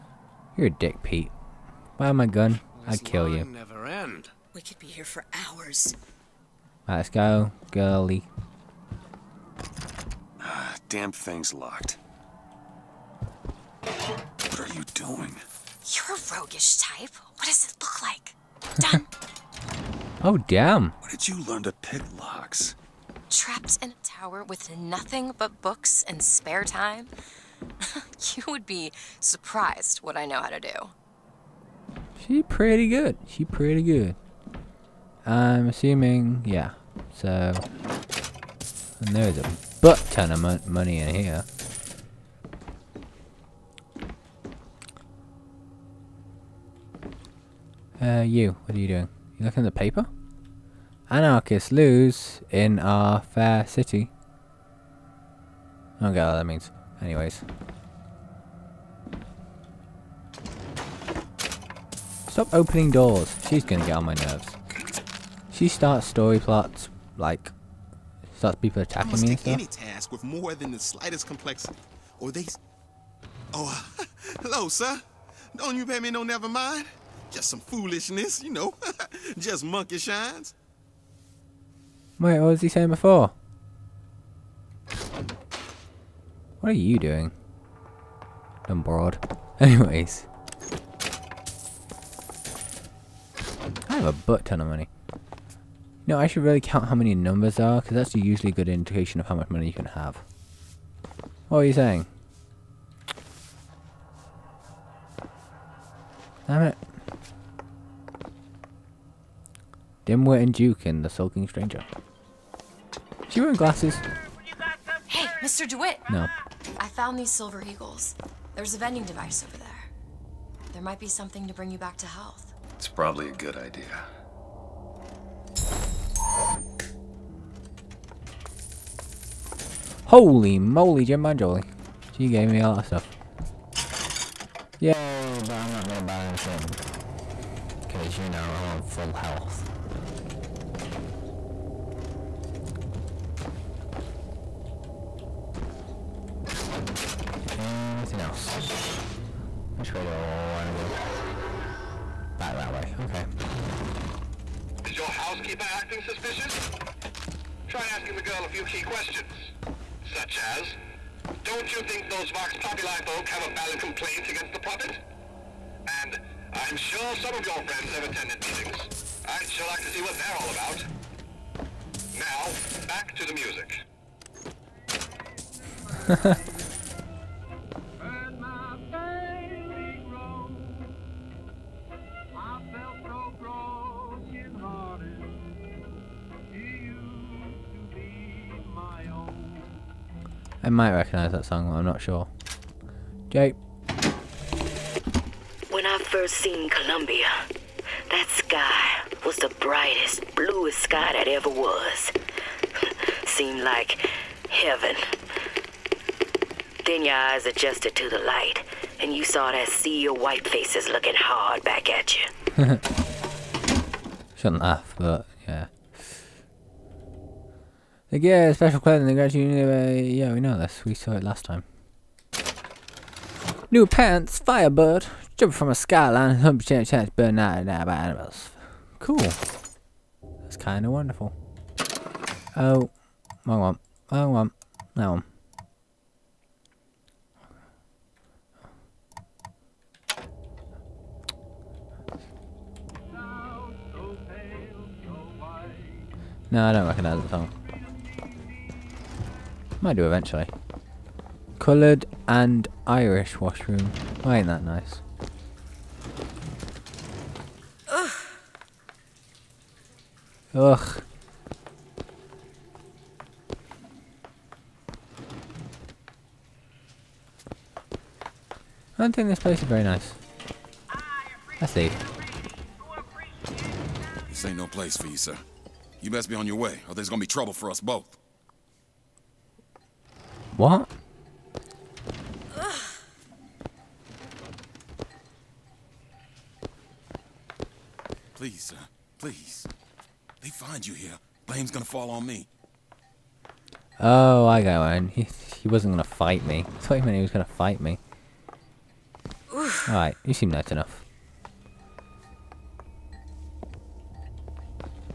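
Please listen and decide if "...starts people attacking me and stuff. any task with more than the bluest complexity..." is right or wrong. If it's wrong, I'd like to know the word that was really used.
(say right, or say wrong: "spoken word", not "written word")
wrong: "slightest", not "bluest".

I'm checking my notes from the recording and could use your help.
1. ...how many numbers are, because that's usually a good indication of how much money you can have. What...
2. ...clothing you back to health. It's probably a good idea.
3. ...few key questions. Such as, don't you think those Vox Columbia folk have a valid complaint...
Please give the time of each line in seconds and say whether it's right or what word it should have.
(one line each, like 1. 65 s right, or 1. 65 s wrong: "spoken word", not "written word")
1. 96 s right
2. 121 s wrong: "bring", not "clothing"
3. 158 s wrong: "Populi", not "Columbia".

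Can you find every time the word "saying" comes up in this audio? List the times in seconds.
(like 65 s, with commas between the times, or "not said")
82 s, 101 s.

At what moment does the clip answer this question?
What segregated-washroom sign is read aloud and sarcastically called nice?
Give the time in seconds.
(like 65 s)
251 s.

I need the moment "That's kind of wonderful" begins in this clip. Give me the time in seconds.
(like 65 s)
230 s.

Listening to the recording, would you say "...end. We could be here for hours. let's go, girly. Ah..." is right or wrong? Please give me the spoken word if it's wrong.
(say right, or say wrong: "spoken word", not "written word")
right.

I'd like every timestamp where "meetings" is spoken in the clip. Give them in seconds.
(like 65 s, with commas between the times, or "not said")
168 s.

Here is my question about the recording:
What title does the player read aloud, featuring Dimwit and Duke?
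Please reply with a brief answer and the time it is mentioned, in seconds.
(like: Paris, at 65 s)
The Sulking Stranger, at 111 s.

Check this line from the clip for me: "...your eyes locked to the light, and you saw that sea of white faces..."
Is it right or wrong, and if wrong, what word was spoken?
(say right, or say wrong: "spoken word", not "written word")
wrong: "adjusted", not "locked".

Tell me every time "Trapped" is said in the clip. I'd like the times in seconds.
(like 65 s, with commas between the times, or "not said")
23 s.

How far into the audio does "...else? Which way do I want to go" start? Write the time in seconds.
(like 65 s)
148 s.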